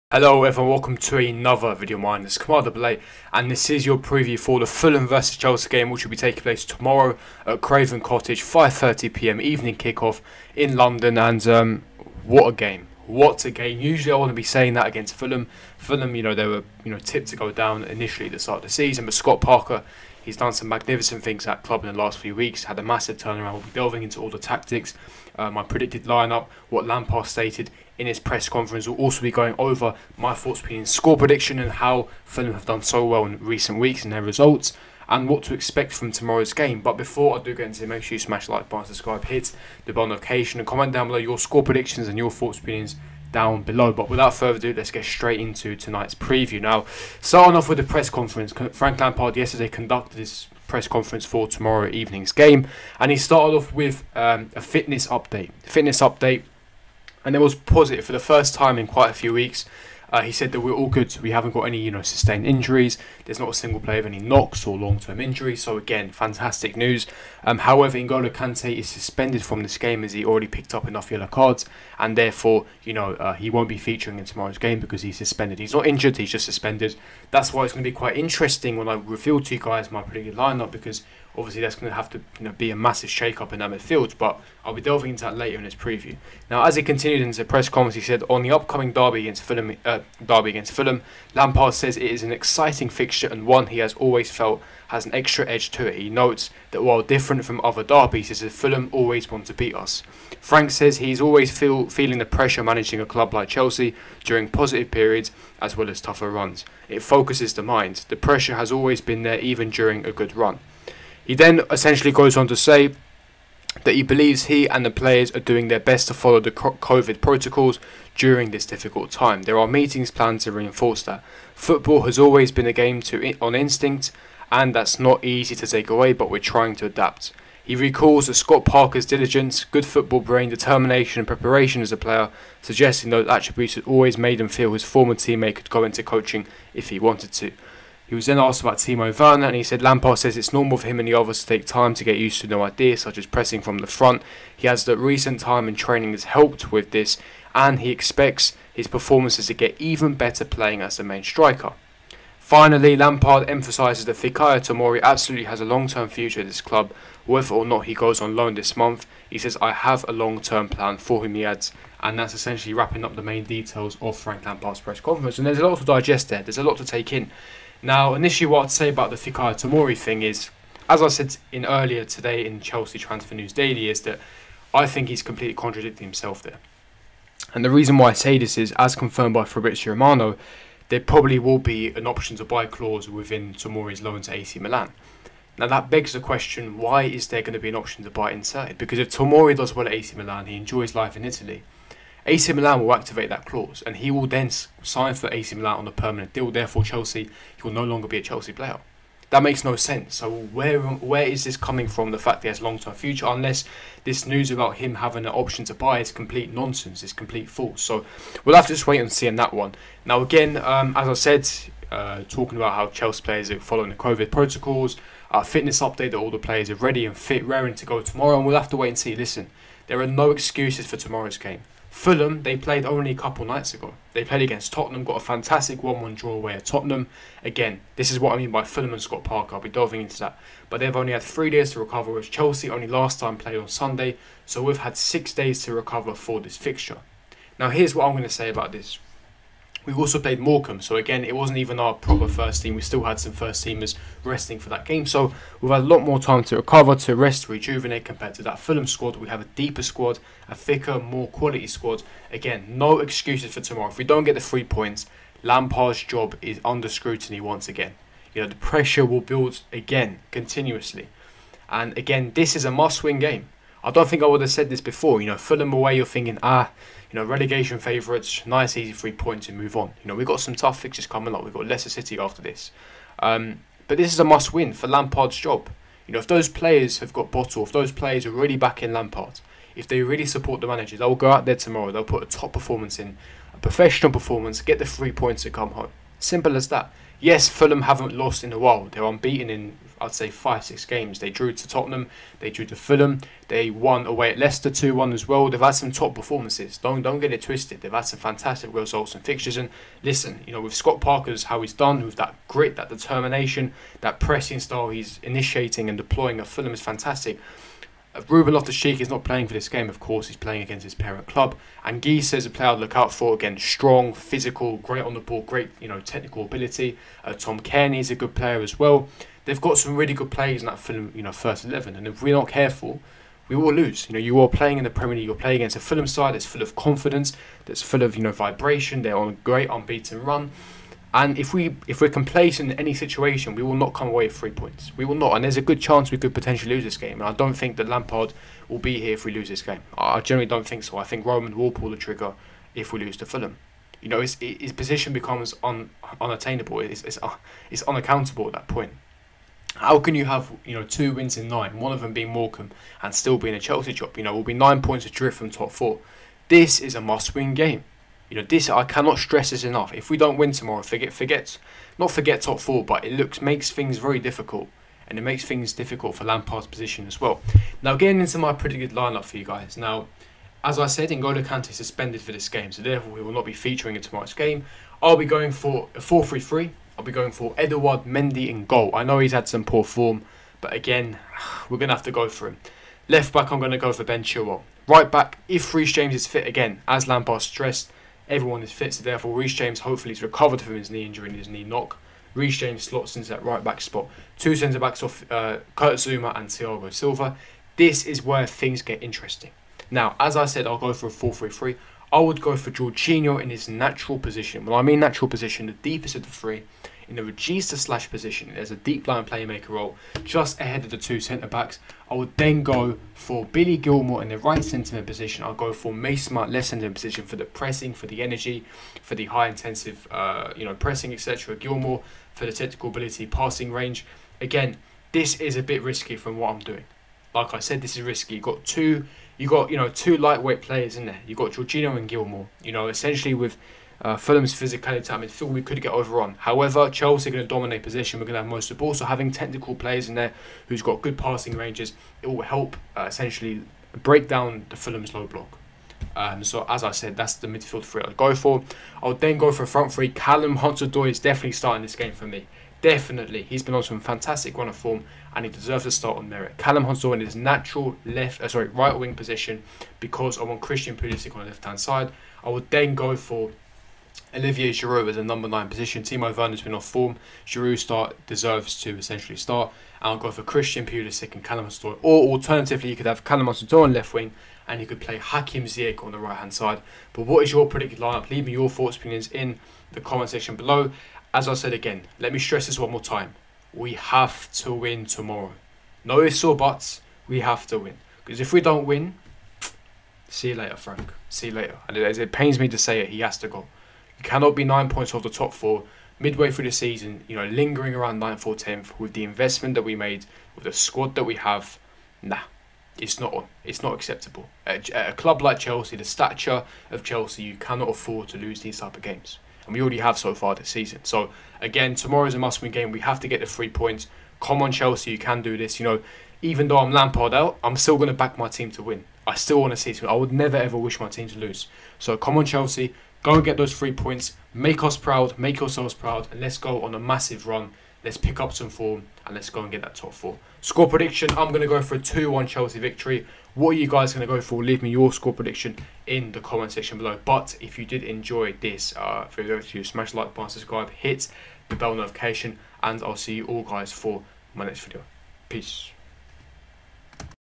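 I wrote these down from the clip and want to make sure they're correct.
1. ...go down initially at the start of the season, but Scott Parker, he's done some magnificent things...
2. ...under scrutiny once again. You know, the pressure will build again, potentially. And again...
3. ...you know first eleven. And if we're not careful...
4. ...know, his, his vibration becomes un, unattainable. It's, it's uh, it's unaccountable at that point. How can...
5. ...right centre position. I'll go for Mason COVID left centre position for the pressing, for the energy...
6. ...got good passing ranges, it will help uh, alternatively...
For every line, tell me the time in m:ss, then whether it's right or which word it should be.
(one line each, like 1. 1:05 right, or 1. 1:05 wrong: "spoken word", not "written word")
1. 0:17 right
2. 4:16 wrong: "continuously", not "potentially"
3. 5:21 right
4. 5:44 wrong: "position", not "vibration"
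5. 6:54 wrong: "Mount", not "COVID"
6. 7:20 wrong: "essentially", not "alternatively".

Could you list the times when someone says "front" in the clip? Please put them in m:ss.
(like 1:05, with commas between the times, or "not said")
2:23, 7:29.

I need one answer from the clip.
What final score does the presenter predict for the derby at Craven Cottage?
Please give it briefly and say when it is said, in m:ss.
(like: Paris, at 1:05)
2-1 Chelsea, at 8:51.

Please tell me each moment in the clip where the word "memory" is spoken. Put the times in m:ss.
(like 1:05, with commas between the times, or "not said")
not said.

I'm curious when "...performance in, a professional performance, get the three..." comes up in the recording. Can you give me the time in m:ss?
4:42.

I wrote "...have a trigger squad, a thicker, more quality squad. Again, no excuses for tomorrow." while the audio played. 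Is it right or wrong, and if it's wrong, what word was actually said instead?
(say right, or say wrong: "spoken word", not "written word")
wrong: "deeper", not "trigger".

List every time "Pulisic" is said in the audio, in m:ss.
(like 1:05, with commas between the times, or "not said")
7:40, 7:50.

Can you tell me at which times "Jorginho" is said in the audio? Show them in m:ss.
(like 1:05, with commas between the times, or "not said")
6:42, 7:11.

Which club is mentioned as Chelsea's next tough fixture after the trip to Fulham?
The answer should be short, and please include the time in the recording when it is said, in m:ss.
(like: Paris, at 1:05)
Leicester City, at 4:31.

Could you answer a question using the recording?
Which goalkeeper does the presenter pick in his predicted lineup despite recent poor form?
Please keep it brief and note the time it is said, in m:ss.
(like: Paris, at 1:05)
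Eduard Mendy, at 6:17.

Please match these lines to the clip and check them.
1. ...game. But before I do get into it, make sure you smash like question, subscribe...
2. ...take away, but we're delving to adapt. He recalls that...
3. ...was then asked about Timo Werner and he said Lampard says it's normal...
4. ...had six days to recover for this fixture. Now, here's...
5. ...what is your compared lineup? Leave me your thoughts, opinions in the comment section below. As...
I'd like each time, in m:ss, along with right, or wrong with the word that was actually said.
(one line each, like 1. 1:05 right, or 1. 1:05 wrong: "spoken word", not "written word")
1. 0:36 wrong: "button", not "question"
2. 2:05 wrong: "trying", not "delving"
3. 2:18 right
4. 3:54 right
5. 7:57 wrong: "predicted", not "compared".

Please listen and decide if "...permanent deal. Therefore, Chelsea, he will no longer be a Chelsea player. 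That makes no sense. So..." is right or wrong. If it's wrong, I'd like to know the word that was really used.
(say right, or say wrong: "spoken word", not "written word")
right.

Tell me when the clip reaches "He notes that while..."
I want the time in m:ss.
1:35.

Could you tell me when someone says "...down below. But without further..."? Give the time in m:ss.
0:43.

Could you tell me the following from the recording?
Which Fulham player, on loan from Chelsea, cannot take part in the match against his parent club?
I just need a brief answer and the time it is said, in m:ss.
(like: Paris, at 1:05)
Ruben Loftus-Cheek, at 5:08.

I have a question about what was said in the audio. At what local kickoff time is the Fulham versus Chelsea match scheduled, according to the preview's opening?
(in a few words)
5:30 p.m.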